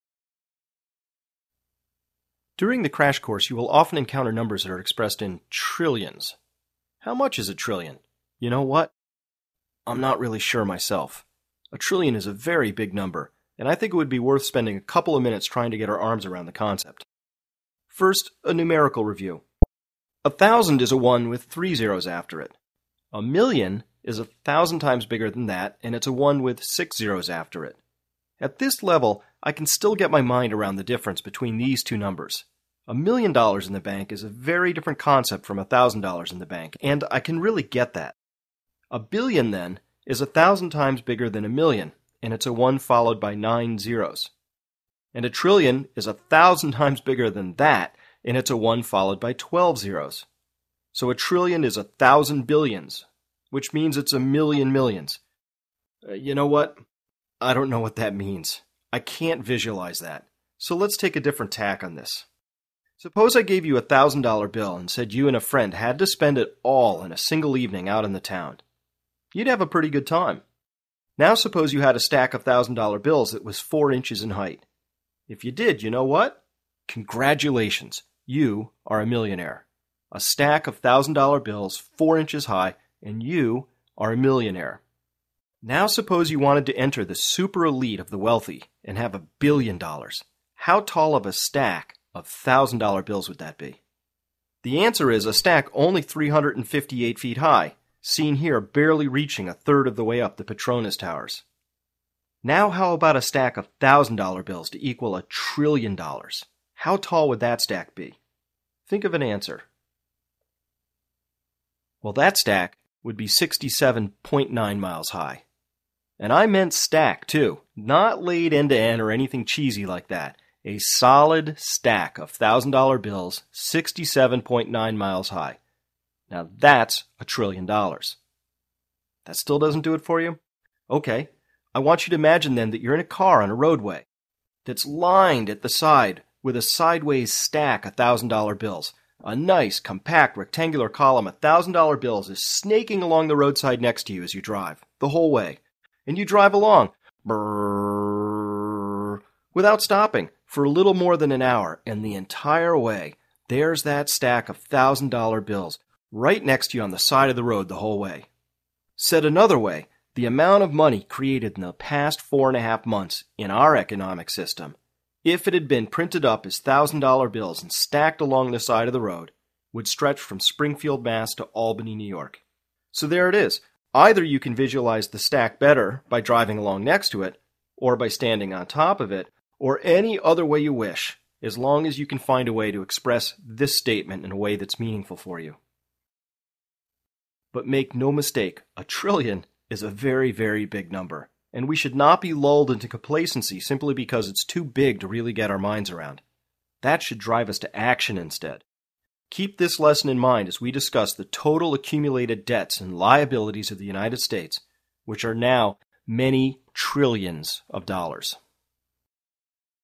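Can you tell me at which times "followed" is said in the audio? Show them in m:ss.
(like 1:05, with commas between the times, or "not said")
0:42, 0:48.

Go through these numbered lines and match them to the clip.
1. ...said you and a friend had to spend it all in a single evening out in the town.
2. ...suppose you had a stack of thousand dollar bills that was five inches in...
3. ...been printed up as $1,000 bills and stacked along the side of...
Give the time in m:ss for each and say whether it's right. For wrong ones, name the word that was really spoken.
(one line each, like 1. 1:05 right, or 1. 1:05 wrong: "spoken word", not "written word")
1. 1:04 right
2. 1:11 wrong: "four", not "five"
3. 2:45 right.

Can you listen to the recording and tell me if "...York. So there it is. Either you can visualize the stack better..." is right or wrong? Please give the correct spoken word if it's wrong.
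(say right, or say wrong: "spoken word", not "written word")
right.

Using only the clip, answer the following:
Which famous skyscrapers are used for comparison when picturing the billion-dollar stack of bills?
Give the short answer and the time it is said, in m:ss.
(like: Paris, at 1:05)
Petronas Towers, at 1:40.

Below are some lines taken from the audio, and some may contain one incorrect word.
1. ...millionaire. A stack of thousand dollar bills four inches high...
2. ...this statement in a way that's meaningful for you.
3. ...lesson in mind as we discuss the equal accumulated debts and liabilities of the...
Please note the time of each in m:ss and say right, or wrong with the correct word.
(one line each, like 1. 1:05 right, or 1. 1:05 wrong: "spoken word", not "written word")
1. 1:19 right
2. 3:03 right
3. 3:19 wrong: "total", not "equal".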